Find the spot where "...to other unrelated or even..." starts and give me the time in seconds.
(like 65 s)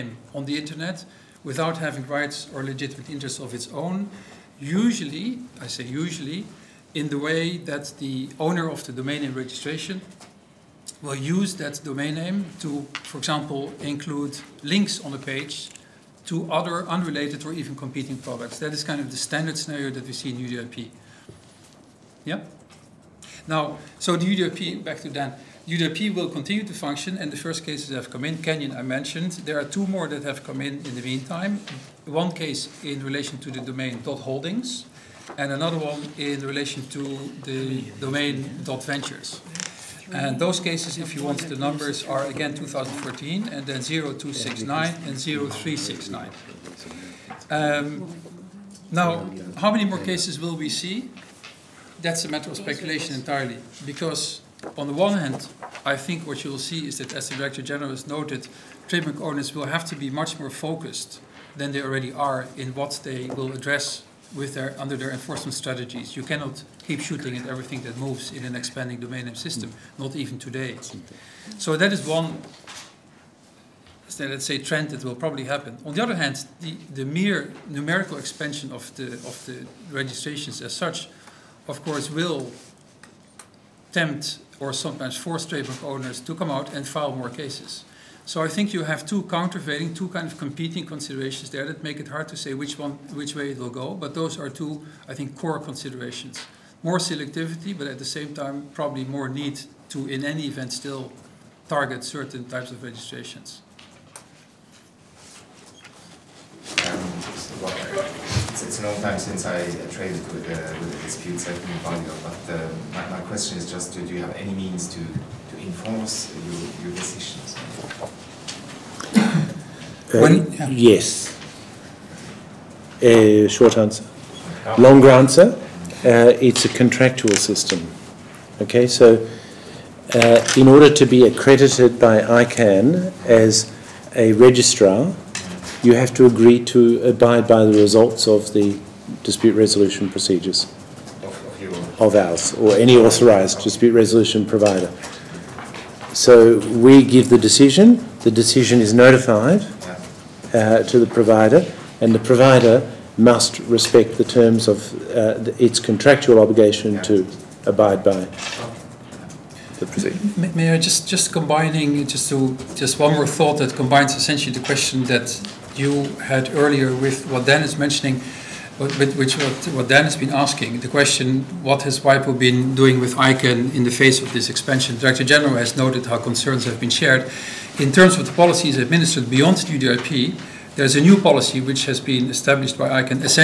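16 s.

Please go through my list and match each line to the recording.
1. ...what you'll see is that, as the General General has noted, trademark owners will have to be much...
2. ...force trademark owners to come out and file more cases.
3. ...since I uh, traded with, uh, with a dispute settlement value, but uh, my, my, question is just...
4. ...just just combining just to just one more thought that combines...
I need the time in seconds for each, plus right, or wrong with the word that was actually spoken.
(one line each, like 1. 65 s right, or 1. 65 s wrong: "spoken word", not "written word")
1. 56 s wrong: "Director", not "General"
2. 85 s right
3. 109 s right
4. 160 s right.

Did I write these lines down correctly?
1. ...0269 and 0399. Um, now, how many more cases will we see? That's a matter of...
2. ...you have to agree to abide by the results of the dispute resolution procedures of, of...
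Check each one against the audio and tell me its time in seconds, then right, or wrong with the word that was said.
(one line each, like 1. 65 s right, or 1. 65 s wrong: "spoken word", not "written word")
1. 43 s wrong: "0369", not "0399"
2. 135 s right.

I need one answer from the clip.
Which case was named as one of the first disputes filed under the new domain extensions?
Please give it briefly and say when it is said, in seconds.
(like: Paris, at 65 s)
Canyon, at 28 s.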